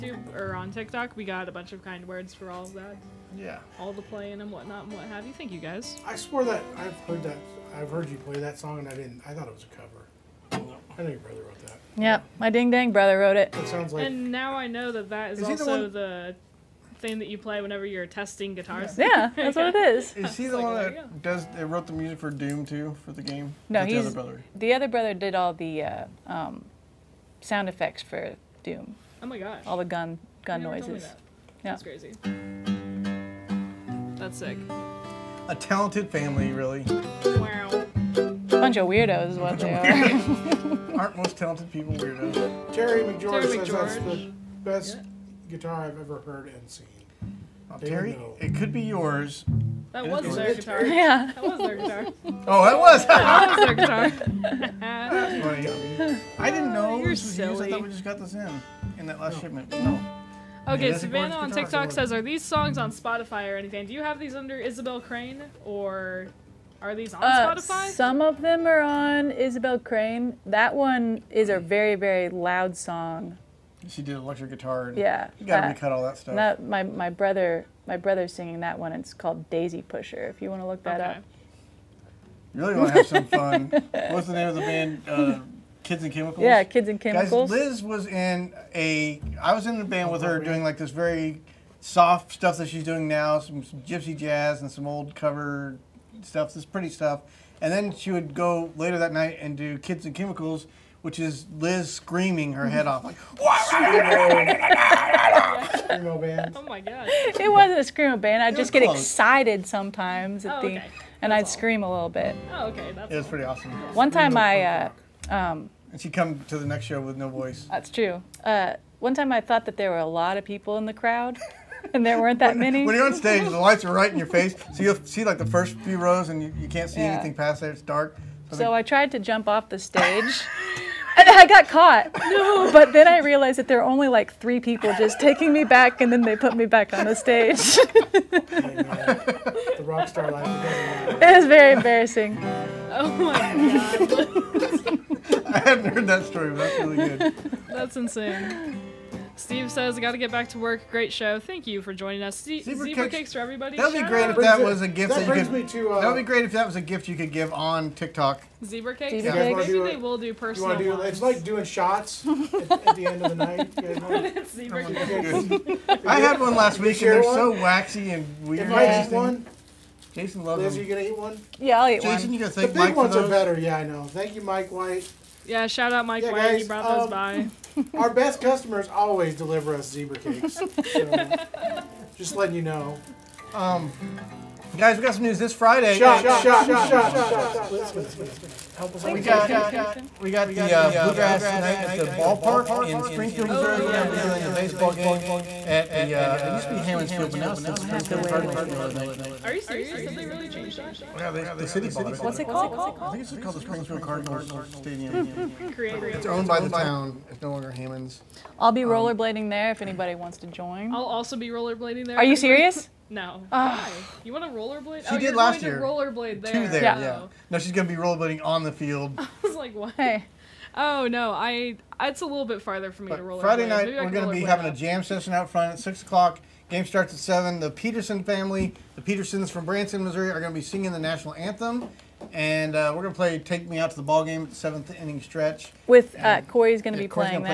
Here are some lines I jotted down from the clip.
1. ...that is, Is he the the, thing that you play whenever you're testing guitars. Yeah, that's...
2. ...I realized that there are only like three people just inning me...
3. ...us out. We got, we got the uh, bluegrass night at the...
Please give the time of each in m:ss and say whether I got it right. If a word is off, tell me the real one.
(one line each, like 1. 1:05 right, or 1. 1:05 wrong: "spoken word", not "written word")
1. 0:15 right
2. 2:13 wrong: "taking", not "inning"
3. 3:08 right.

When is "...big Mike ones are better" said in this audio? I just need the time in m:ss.
2:52.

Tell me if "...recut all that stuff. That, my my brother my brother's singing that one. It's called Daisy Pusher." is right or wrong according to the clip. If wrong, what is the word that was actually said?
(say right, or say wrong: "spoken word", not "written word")
right.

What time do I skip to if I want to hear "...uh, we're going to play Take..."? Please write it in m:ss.
3:52.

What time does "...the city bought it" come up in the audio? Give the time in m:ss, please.
3:21.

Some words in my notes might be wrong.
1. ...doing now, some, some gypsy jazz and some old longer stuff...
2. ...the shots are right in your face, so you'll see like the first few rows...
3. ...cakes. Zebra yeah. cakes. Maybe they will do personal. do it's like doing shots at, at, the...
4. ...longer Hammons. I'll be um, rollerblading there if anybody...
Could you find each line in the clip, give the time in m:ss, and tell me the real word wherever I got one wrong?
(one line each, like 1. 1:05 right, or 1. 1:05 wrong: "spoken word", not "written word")
1. 1:32 wrong: "cover", not "longer"
2. 2:03 wrong: "lights", not "shots"
3. 2:38 right
4. 3:27 right.